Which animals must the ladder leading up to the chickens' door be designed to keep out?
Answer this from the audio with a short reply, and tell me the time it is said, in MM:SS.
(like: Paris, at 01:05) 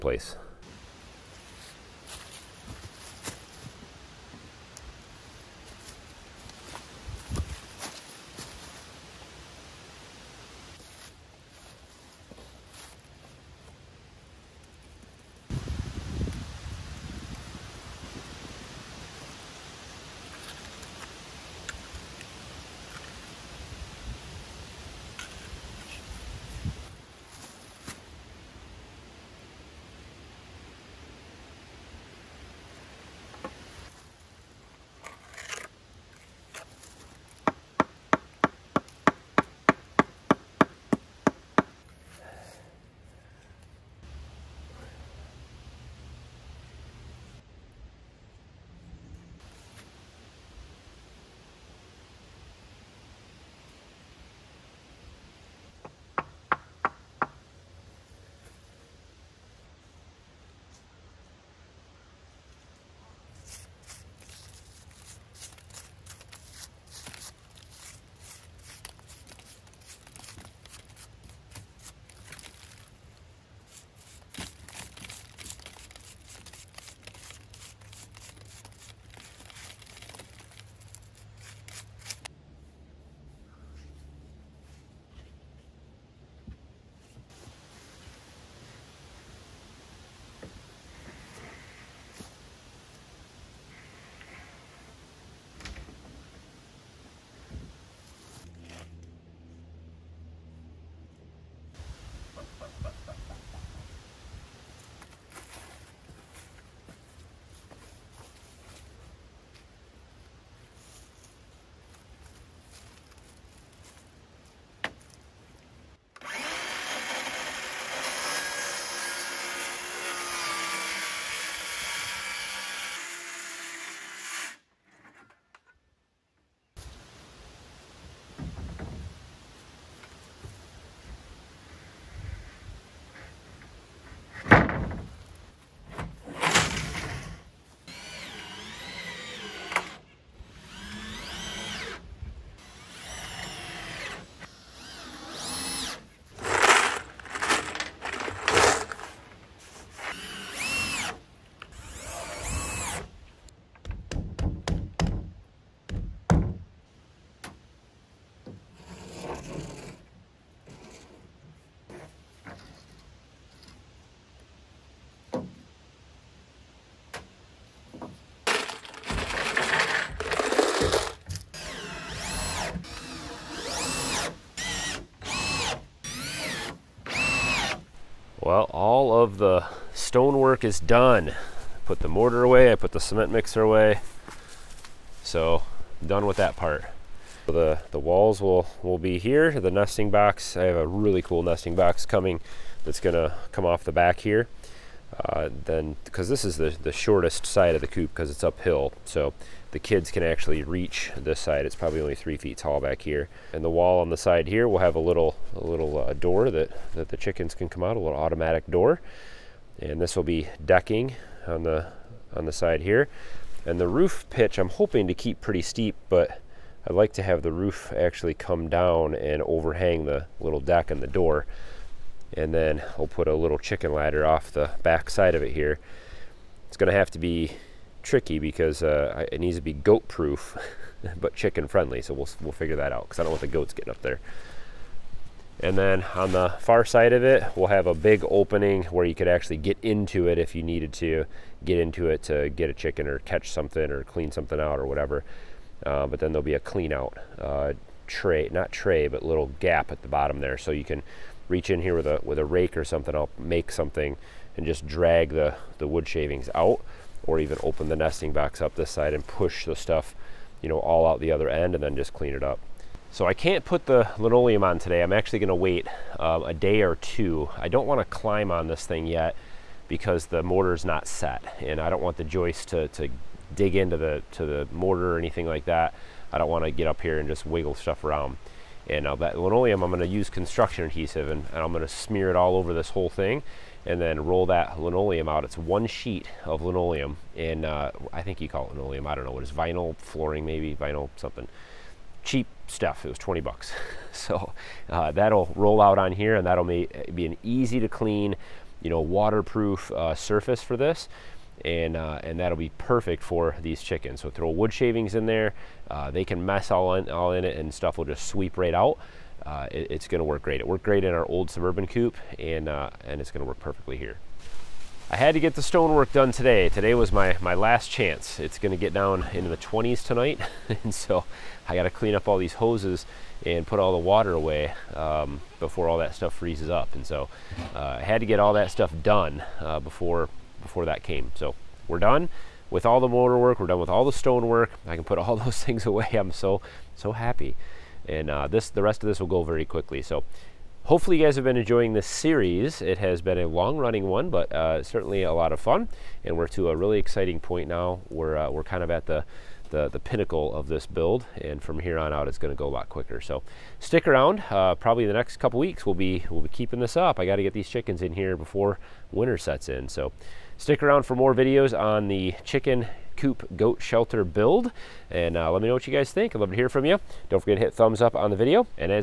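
goats, at 03:53.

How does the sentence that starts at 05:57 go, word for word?
I gotta get these chickens in here before winter sets in.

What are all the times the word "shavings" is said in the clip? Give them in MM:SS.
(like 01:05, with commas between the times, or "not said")
04:16, 05:04.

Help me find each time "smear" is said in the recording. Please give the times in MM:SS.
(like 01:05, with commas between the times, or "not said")
04:41.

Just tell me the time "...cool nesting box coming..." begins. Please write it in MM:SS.
03:11.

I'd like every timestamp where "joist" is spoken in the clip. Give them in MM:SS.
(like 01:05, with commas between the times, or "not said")
04:32.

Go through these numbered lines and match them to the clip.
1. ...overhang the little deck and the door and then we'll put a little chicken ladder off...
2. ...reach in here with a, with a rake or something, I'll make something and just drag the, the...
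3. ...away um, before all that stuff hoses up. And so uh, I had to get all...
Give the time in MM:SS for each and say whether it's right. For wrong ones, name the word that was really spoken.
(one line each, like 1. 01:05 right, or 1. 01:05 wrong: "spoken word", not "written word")
1. 03:39 right
2. 04:11 right
3. 05:24 wrong: "freezes", not "hoses".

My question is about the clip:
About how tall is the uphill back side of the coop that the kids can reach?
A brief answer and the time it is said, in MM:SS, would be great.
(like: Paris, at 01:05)
3 feet, at 03:22.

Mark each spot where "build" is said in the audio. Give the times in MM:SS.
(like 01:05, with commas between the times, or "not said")
05:50, 06:04.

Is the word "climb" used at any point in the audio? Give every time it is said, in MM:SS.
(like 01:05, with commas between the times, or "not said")
04:28.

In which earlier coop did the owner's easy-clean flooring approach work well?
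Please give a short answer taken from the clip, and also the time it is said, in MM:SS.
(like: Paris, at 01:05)
Suburban coop, at 05:11.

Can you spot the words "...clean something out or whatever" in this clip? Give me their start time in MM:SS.
04:04.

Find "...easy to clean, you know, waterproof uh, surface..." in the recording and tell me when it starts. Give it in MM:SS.
04:57.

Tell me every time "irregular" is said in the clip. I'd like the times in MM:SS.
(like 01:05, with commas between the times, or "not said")
not said.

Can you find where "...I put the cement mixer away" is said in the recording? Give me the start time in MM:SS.
03:02.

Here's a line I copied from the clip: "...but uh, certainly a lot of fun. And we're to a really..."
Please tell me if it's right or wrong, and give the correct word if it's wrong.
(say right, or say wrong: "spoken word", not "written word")
right.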